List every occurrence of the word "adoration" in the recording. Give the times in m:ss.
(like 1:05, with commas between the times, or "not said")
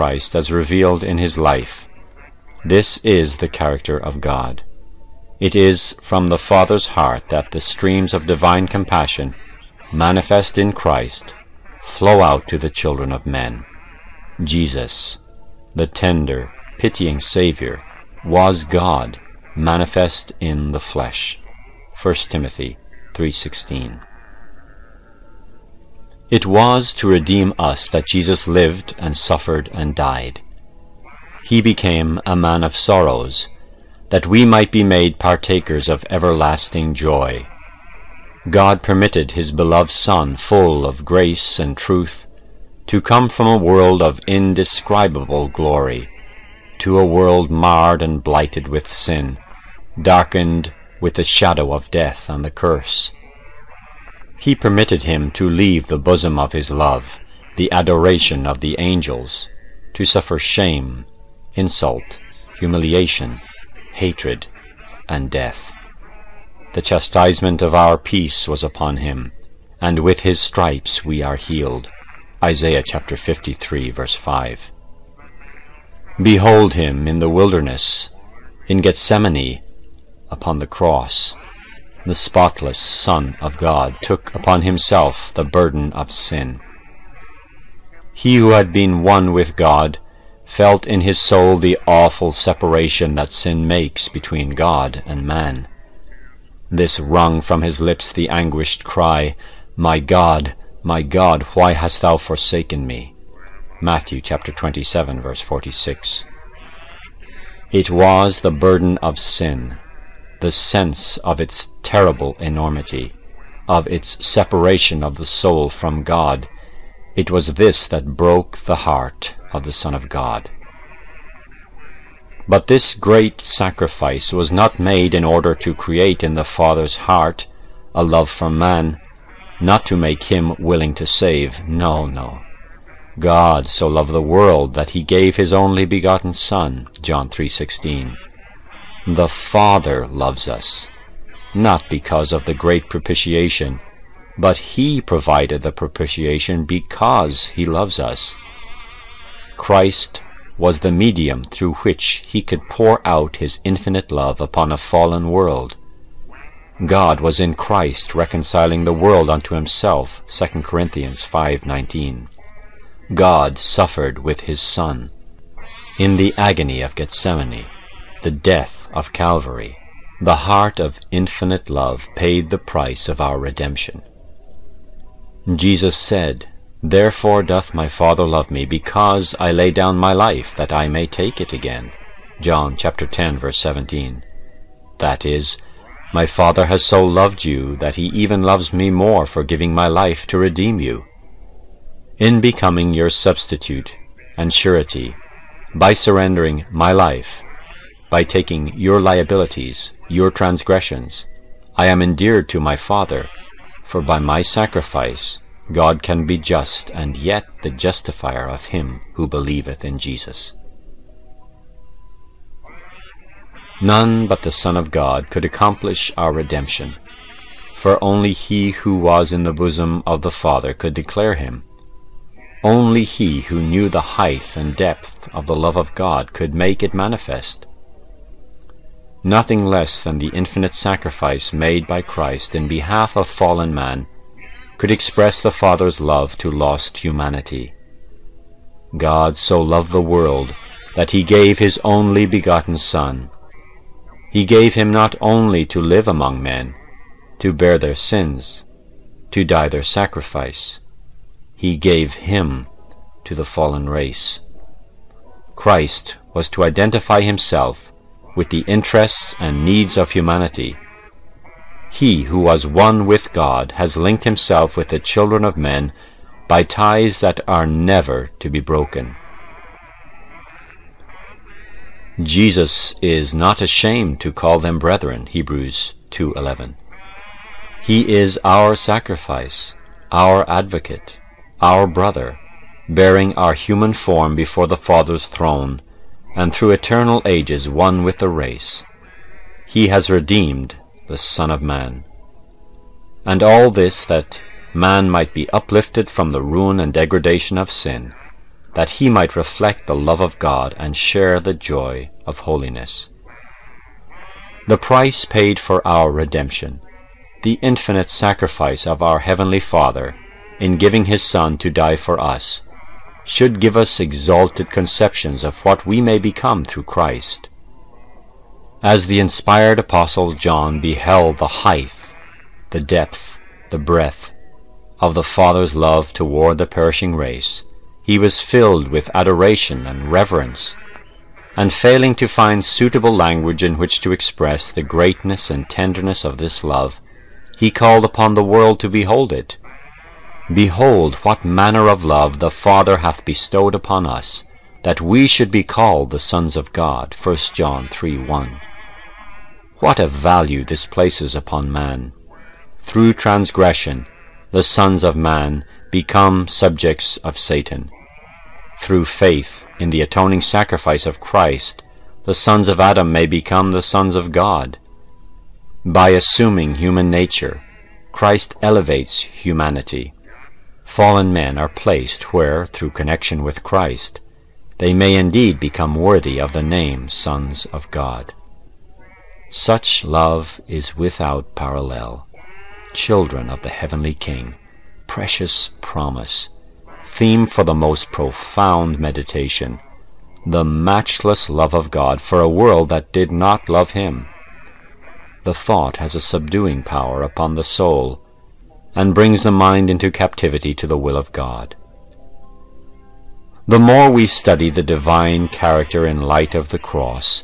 0:57, 5:29.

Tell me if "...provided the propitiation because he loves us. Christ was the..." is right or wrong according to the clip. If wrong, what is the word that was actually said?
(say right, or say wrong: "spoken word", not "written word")
right.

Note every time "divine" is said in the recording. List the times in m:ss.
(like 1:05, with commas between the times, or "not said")
0:08, 6:44.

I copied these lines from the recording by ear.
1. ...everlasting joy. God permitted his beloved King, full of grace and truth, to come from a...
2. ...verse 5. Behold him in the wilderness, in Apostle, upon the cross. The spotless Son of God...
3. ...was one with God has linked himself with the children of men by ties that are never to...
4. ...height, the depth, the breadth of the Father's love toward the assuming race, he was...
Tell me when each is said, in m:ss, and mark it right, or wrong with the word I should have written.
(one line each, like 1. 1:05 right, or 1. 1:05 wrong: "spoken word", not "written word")
1. 0:36 wrong: "Son", not "King"
2. 1:13 wrong: "Gethsemane", not "Apostle"
3. 4:22 right
4. 5:21 wrong: "perishing", not "assuming".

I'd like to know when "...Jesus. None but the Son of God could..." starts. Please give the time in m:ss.
3:29.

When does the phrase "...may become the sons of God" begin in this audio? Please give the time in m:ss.
6:03.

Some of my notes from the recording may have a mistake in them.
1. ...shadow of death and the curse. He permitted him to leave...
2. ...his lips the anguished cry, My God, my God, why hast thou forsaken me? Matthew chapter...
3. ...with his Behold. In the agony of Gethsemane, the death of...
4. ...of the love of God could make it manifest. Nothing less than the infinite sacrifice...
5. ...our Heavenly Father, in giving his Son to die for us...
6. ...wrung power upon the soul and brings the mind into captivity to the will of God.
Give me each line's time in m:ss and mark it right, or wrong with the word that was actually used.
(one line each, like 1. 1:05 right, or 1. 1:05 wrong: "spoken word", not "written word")
1. 0:51 right
2. 1:37 right
3. 2:44 wrong: "Son", not "Behold"
4. 3:45 right
5. 5:09 right
6. 6:36 wrong: "subduing", not "wrung".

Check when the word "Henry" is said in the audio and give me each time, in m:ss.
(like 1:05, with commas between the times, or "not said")
not said.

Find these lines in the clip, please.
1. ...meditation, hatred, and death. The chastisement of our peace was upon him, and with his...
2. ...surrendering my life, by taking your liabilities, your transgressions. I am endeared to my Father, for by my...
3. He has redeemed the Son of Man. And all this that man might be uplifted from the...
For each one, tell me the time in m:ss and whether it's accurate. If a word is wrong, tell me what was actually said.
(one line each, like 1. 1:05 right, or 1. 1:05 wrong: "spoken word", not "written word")
1. 1:02 wrong: "humiliation", not "meditation"
2. 3:15 right
3. 4:49 right.